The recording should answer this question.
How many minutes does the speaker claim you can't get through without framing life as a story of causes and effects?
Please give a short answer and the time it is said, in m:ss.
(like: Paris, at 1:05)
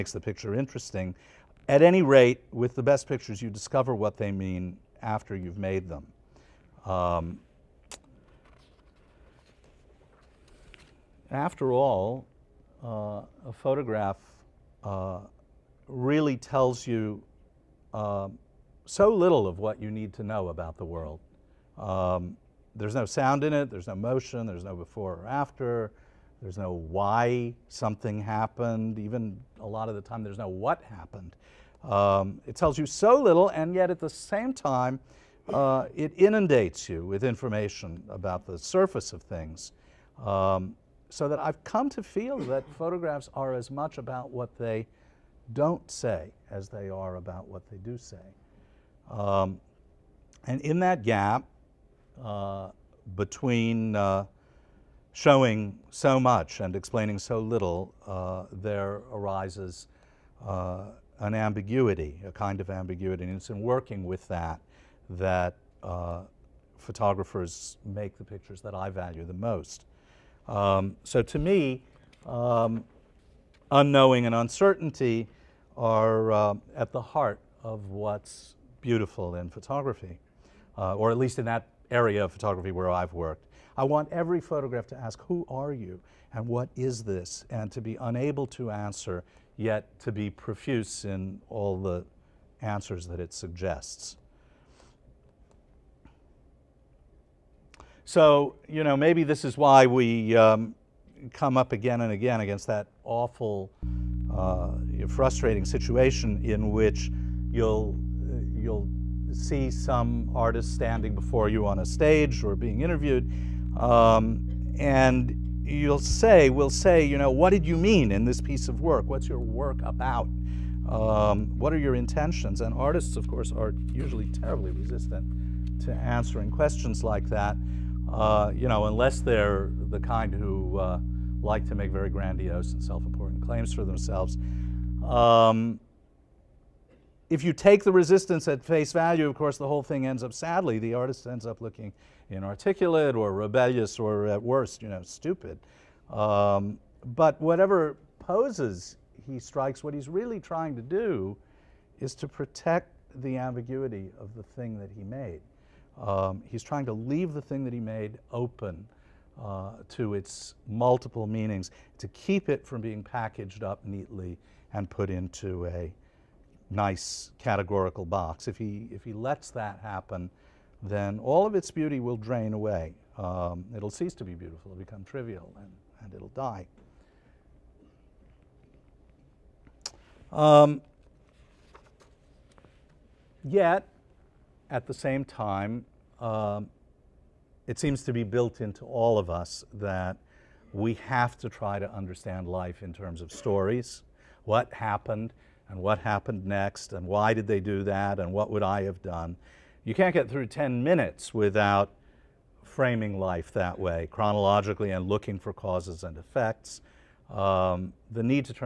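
10, at 3:20.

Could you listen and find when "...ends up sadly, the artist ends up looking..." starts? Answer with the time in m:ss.
2:20.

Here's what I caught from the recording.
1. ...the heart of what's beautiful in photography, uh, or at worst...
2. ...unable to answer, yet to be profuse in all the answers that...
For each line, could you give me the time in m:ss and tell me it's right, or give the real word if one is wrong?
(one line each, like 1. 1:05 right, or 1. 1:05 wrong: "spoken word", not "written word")
1. 1:16 wrong: "least", not "worst"
2. 1:28 right.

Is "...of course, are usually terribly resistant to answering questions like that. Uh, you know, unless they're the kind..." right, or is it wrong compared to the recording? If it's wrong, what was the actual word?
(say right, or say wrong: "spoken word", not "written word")
right.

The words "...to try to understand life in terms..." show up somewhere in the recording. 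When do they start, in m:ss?
3:11.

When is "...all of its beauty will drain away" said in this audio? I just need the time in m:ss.
2:51.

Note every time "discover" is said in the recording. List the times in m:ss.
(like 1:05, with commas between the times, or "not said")
0:03.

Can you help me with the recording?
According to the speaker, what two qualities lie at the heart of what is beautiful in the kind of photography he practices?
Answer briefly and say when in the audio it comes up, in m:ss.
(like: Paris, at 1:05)
unknowing and uncertainty, at 1:13.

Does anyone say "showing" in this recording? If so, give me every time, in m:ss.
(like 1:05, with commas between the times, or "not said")
0:55.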